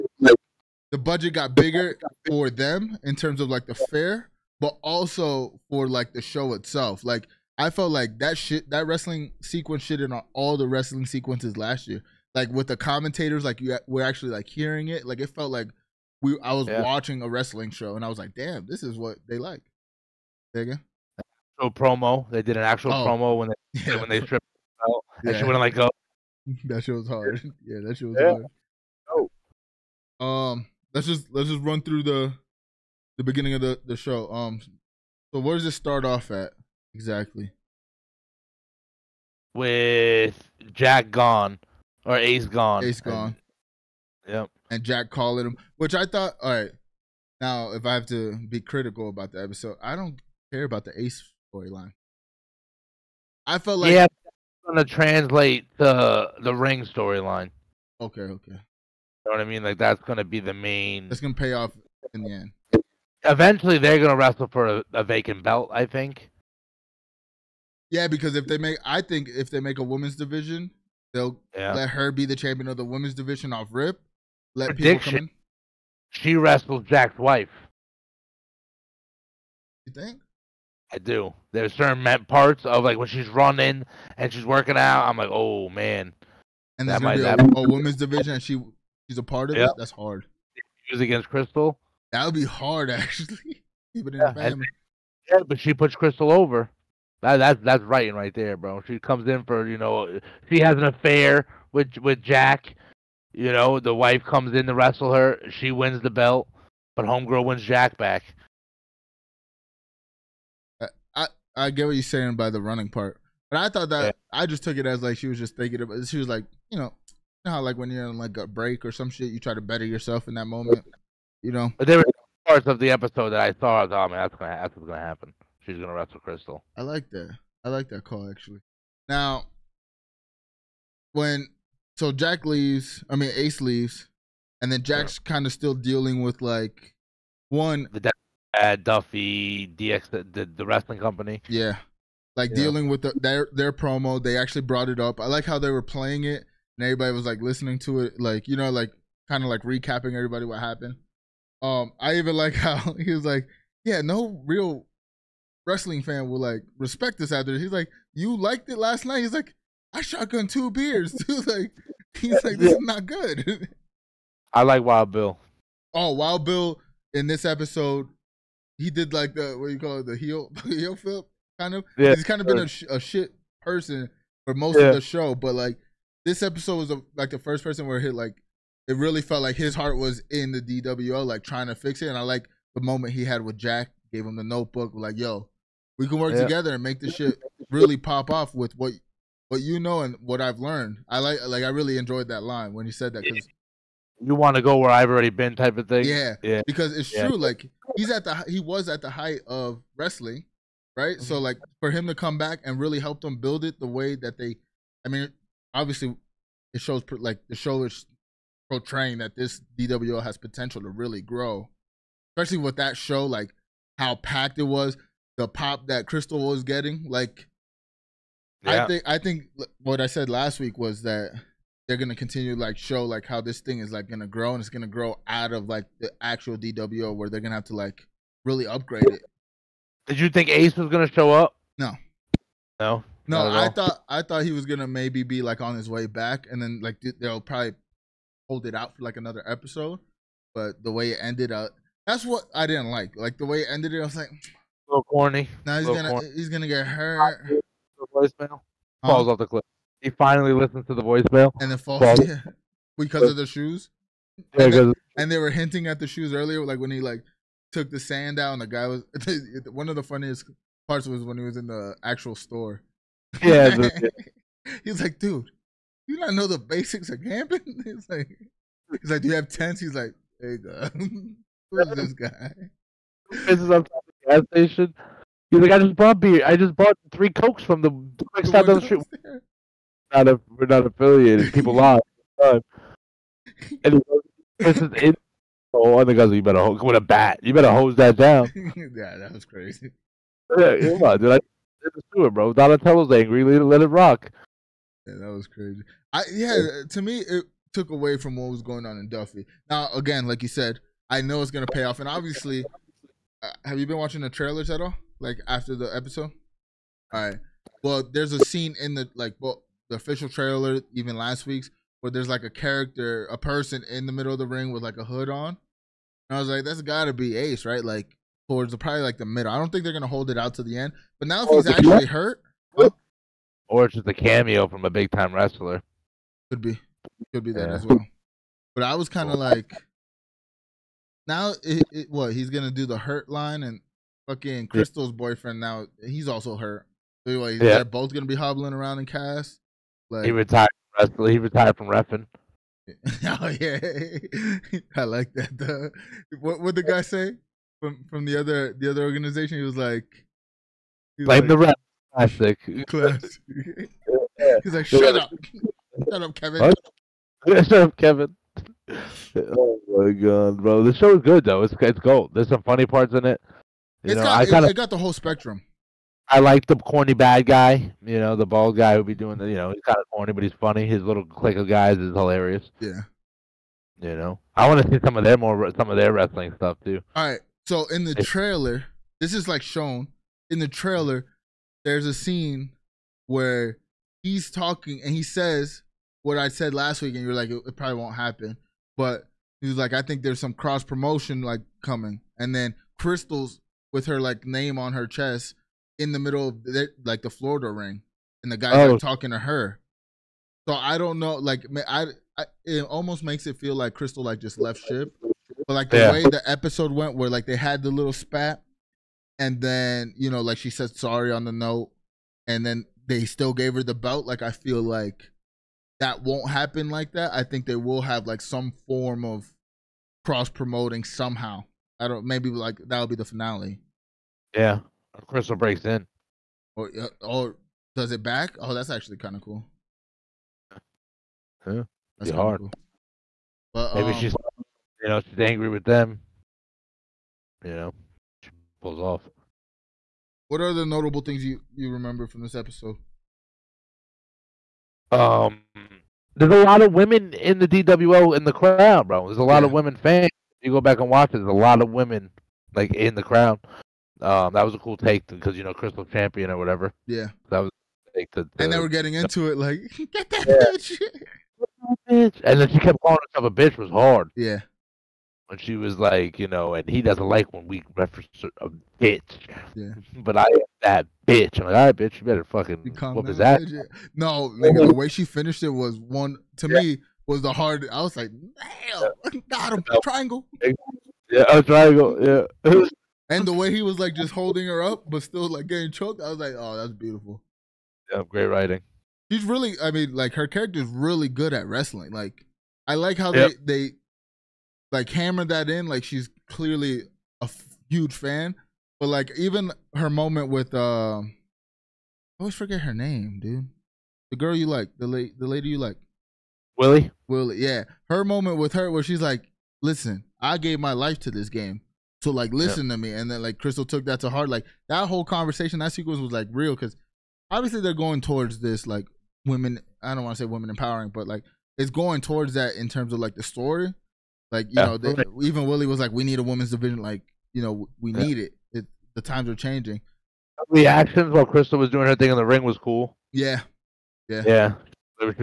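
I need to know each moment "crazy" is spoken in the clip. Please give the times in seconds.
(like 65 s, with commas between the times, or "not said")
289 s, 295 s.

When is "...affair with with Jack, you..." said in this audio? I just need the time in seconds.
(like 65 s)
100 s.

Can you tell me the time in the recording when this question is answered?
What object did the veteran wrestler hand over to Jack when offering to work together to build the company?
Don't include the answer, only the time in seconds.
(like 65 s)
184 s.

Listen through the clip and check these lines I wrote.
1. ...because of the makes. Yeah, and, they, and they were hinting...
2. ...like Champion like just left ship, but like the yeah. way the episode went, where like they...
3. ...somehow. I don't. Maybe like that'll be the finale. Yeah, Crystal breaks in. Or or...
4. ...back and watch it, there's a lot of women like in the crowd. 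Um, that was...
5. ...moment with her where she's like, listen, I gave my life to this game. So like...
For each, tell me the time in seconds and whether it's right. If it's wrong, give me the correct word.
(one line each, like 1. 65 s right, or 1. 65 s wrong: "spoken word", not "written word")
1. 252 s wrong: "shoes", not "makes"
2. 403 s wrong: "Crystal", not "Champion"
3. 421 s right
4. 450 s right
5. 508 s right.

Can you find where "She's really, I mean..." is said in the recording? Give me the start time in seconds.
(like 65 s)
489 s.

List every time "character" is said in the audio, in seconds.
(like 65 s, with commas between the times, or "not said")
312 s, 490 s.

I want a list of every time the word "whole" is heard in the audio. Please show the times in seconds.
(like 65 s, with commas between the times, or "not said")
364 s, 515 s.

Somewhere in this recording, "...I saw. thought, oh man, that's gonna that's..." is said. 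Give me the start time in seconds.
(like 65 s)
123 s.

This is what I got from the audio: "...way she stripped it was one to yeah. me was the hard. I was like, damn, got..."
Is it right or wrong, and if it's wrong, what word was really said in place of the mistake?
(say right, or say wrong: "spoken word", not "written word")
wrong: "finished", not "stripped".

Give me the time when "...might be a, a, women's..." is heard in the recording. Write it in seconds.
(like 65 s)
87 s.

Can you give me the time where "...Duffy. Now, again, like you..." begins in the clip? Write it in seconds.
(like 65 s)
299 s.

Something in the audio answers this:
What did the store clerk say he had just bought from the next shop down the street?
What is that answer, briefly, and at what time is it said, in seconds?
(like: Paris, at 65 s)
three cokes, at 277 s.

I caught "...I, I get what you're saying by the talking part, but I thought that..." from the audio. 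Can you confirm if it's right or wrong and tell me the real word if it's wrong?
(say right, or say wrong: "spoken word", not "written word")
wrong: "running", not "talking".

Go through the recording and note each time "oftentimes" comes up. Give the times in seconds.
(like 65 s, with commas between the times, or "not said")
not said.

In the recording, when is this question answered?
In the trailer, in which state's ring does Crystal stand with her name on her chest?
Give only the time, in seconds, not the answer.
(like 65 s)
397 s.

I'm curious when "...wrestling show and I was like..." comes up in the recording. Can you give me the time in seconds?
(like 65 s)
17 s.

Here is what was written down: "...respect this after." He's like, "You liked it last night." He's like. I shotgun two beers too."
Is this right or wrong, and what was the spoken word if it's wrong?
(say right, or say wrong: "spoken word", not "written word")
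right.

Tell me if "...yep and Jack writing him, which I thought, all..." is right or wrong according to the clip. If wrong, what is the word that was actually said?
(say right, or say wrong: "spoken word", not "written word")
wrong: "calling", not "writing".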